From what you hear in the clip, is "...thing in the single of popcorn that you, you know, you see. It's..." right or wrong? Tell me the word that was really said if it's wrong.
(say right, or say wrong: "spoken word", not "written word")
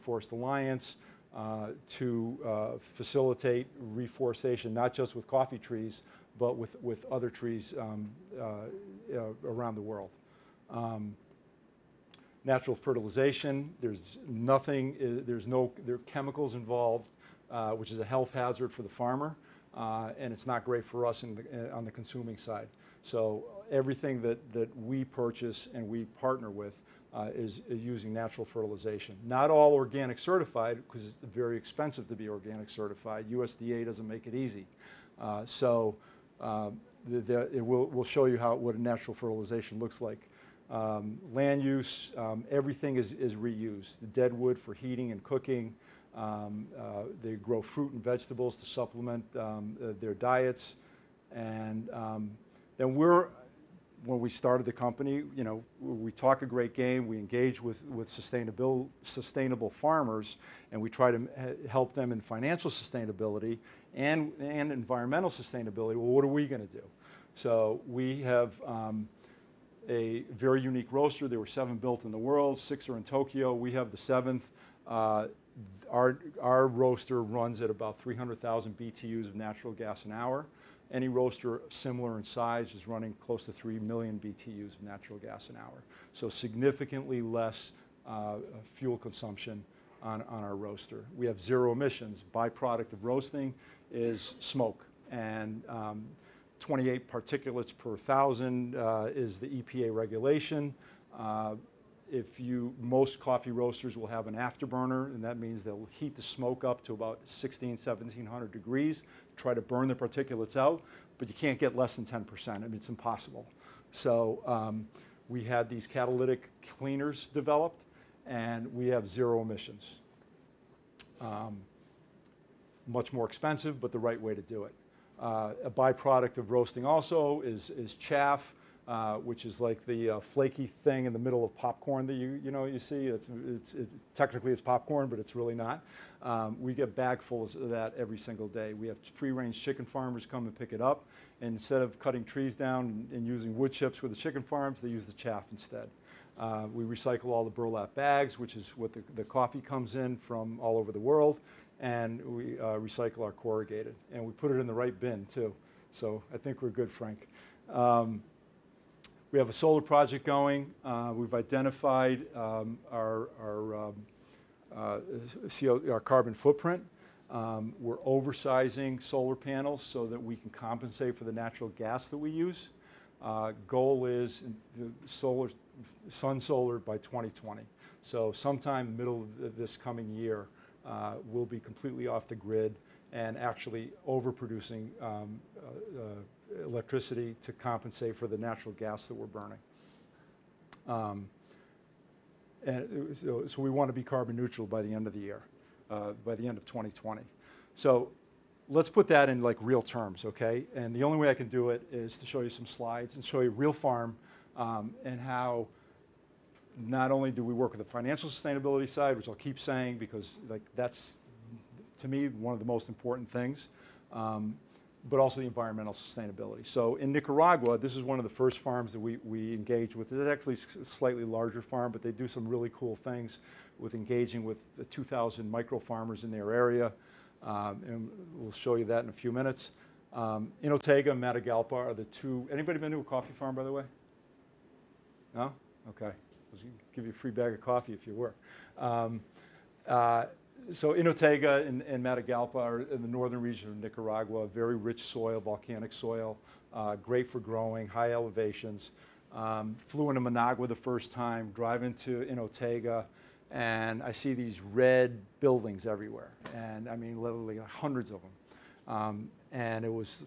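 wrong: "middle", not "single".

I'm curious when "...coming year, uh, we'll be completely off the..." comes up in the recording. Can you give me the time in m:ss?
2:59.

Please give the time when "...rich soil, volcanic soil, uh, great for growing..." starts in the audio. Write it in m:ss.
4:04.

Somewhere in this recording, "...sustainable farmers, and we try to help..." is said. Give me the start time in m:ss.
0:59.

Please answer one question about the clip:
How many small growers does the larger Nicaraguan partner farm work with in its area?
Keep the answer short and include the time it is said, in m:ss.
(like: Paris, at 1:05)
2,000, at 3:44.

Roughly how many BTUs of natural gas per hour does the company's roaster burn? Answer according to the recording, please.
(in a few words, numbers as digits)
300,000 BTUs.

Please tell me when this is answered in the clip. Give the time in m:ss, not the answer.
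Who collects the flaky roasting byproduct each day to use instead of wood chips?
2:19.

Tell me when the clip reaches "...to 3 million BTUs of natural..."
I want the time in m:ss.
1:23.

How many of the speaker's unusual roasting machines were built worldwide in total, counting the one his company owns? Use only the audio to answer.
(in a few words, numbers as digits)
7.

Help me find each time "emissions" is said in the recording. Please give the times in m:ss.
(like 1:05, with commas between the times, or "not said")
1:31, 1:59.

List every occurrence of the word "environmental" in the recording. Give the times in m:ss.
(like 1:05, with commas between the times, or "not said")
1:04, 3:35.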